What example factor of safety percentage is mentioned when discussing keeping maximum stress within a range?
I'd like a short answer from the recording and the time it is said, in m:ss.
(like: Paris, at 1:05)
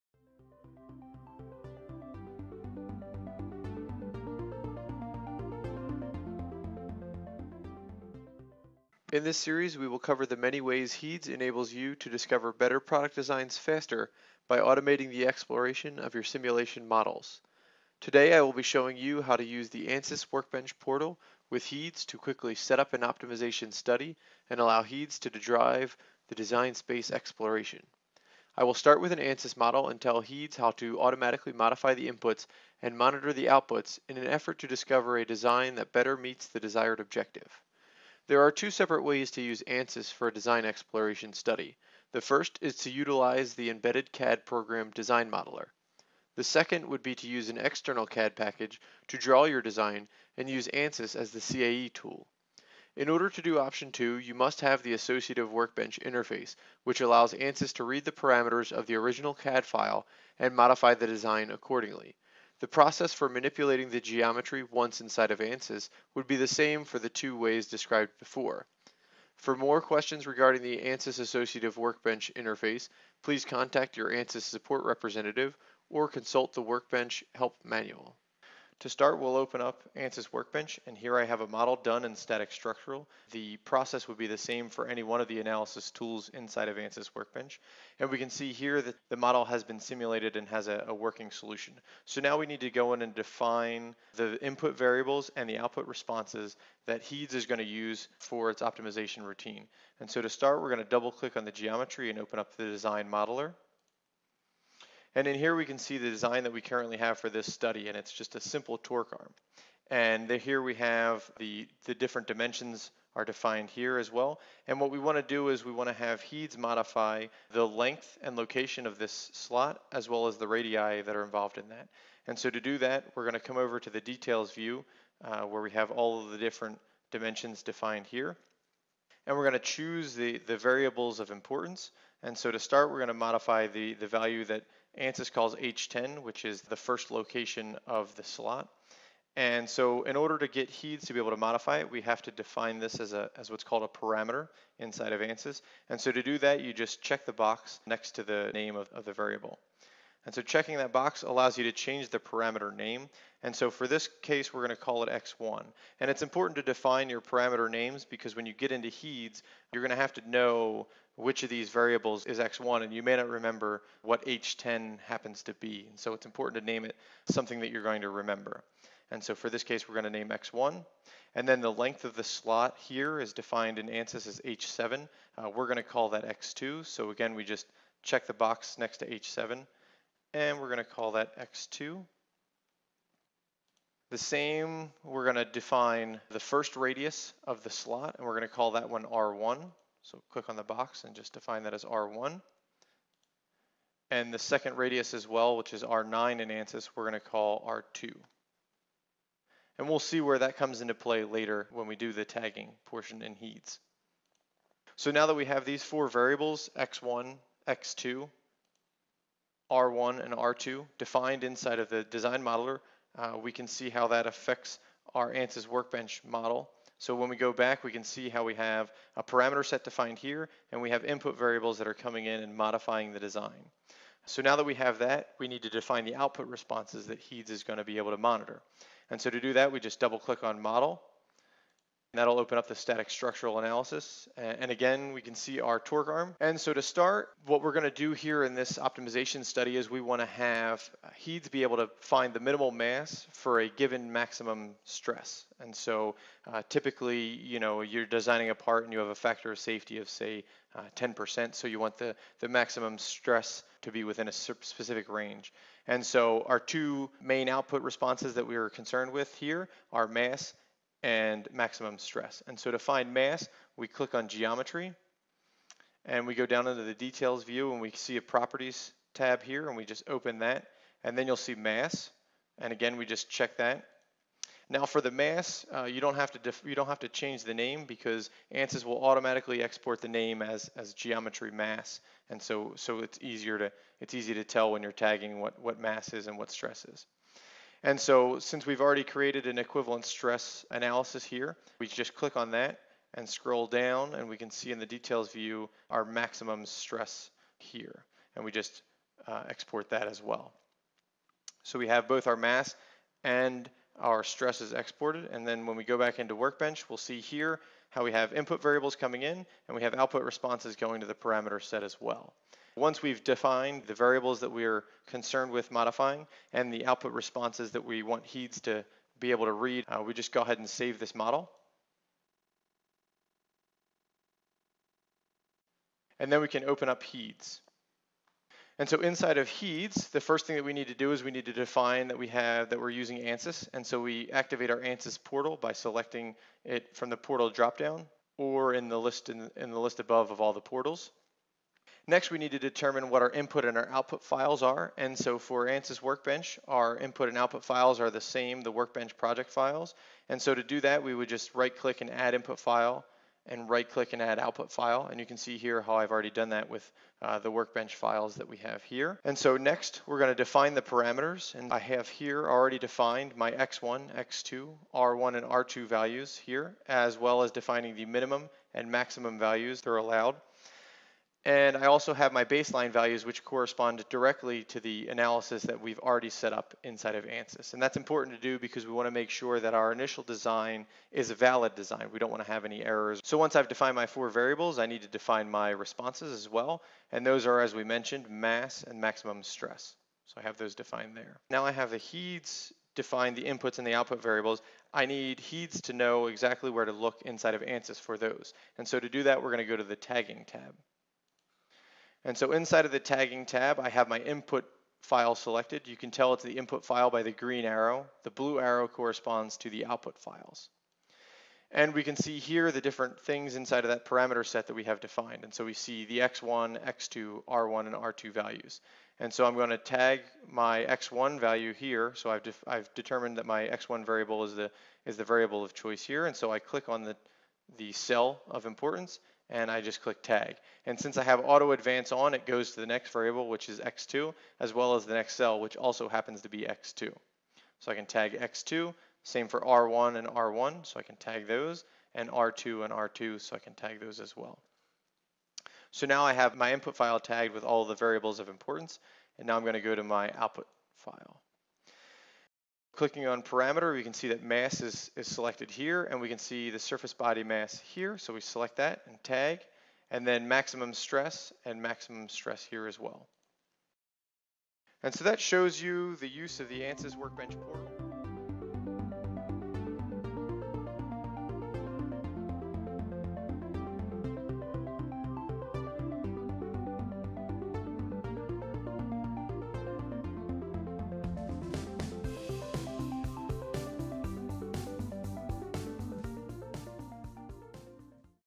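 10%, at 4:10.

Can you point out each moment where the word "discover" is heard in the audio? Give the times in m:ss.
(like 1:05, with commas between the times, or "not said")
0:12, 0:34.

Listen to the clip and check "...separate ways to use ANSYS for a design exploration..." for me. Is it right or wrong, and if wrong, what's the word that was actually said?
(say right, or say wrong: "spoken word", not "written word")
right.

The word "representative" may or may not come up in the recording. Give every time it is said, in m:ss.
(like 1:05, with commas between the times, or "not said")
1:14.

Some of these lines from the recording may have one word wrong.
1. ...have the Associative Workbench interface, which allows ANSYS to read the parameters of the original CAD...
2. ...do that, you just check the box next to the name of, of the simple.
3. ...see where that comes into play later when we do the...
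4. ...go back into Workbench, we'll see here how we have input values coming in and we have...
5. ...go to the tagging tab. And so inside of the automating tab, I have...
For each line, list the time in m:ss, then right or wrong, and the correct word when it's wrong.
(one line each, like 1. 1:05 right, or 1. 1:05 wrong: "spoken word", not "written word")
1. 0:54 right
2. 2:26 wrong: "variable", not "simple"
3. 3:19 right
4. 5:05 wrong: "variables", not "values"
5. 6:39 wrong: "tagging", not "automating".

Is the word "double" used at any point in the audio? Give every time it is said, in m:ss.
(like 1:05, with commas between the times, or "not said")
1:40, 3:49.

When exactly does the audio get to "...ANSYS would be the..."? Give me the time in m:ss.
1:05.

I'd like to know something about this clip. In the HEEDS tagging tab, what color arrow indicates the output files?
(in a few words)
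Blue.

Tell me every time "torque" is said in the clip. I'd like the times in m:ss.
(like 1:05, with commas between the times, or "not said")
1:48, 3:55.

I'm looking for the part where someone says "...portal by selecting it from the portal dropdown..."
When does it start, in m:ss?
5:35.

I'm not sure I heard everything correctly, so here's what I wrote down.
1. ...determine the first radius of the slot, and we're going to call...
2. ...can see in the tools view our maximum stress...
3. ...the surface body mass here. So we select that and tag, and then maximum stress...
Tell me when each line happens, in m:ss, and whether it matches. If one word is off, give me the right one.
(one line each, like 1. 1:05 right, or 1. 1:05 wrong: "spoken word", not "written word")
1. 3:05 wrong: "define", not "determine"
2. 4:54 wrong: "details", not "tools"
3. 7:36 right.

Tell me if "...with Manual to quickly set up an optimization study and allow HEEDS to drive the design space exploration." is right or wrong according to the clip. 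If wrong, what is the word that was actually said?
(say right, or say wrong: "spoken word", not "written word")
wrong: "HEEDS", not "Manual".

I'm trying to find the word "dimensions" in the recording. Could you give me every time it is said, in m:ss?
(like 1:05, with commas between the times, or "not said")
1:52, 2:07.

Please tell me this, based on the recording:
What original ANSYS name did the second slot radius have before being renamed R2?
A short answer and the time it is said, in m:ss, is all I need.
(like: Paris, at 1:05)
R9, at 3:15.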